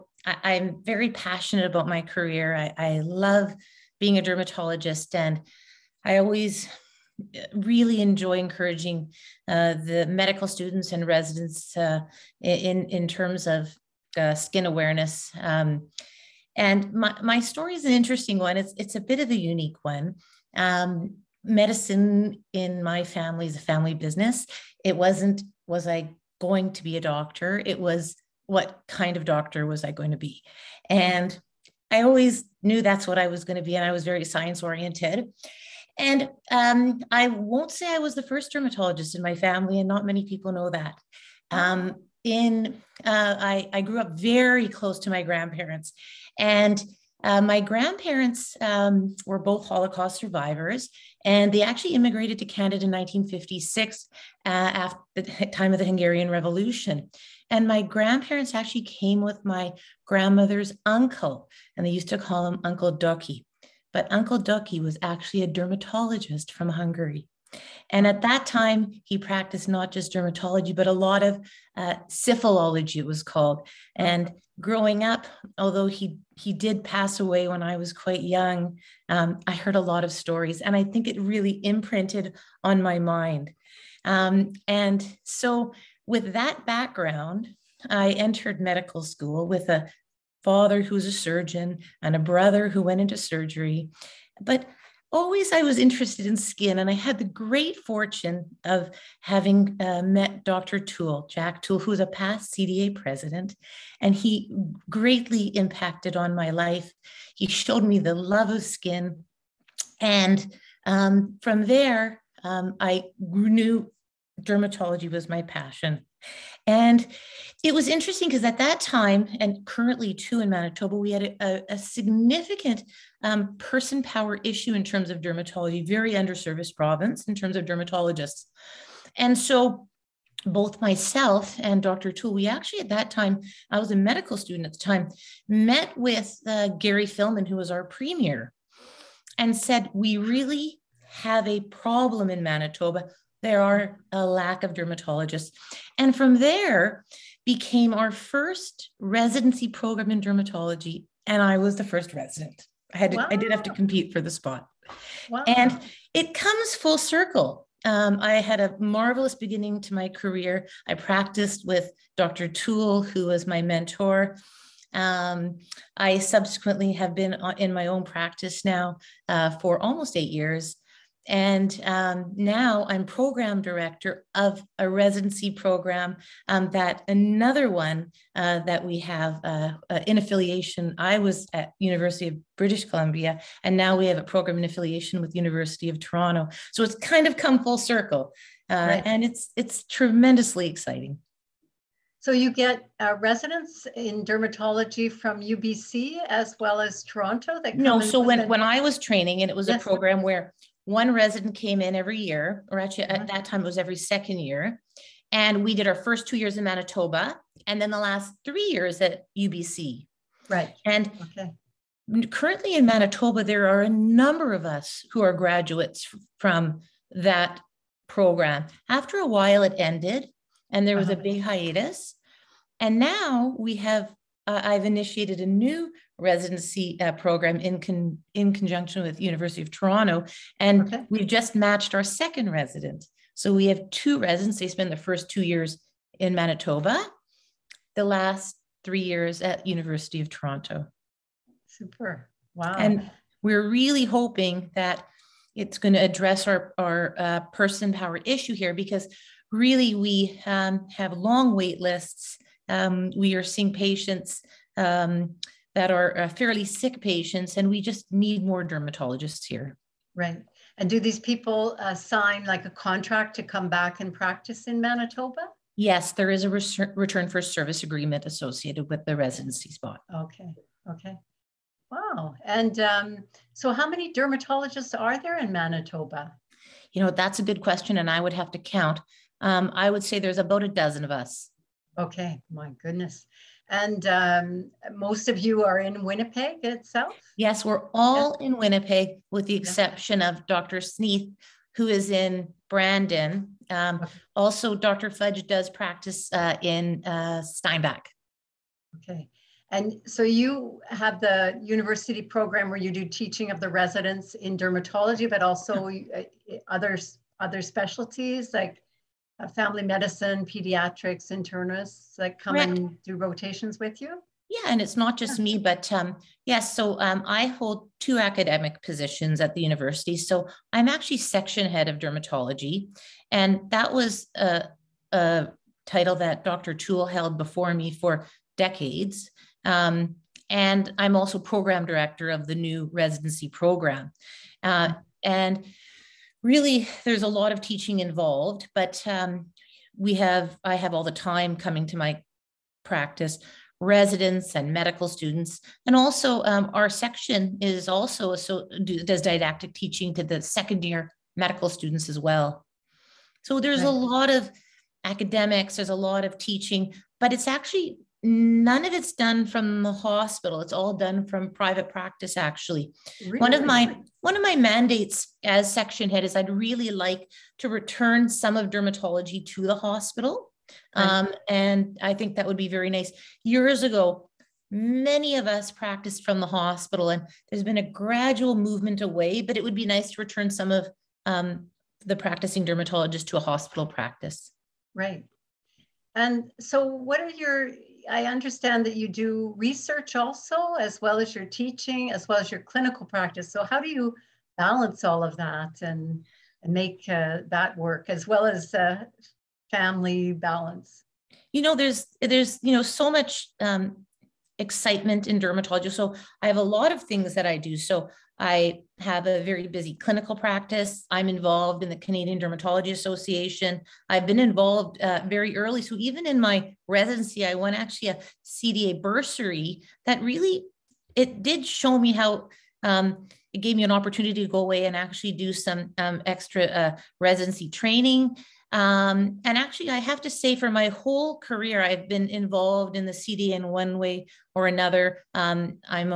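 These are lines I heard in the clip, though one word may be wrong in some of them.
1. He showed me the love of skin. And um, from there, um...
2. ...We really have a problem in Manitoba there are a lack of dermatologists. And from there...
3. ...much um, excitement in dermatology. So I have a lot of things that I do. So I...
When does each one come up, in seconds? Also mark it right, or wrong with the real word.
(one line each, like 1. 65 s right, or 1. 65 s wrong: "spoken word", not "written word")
1. 107 s right
2. 139 s right
3. 403 s right.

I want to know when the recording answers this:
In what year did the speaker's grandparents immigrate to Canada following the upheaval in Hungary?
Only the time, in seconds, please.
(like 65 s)
52 s.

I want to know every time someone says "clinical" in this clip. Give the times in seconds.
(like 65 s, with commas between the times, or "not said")
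392 s, 409 s.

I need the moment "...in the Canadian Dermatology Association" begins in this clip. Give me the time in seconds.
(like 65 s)
411 s.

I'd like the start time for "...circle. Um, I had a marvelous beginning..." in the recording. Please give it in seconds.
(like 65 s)
156 s.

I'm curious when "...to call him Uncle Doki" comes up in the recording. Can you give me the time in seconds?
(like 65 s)
62 s.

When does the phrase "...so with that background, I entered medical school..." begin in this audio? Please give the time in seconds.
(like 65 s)
85 s.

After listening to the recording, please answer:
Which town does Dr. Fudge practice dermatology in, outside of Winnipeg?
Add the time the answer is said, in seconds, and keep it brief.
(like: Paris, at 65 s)
Steinbach, at 297 s.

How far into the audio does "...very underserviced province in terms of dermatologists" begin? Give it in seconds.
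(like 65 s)
125 s.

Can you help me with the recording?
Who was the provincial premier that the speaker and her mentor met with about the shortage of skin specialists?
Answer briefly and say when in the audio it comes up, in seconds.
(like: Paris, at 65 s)
Gary Filmon, at 136 s.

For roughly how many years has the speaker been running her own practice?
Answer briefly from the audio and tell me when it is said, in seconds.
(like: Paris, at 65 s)
8, at 170 s.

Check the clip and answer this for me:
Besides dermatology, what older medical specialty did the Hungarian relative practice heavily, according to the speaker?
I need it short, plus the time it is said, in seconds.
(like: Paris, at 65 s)
syphilology, at 72 s.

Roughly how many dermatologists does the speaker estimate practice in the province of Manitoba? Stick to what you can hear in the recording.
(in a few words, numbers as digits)
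About 12.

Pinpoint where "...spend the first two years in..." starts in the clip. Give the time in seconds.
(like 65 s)
234 s.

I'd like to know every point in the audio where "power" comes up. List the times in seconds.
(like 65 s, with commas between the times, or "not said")
124 s, 247 s.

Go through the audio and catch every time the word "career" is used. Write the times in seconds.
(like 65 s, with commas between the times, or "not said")
2 s, 160 s, 431 s.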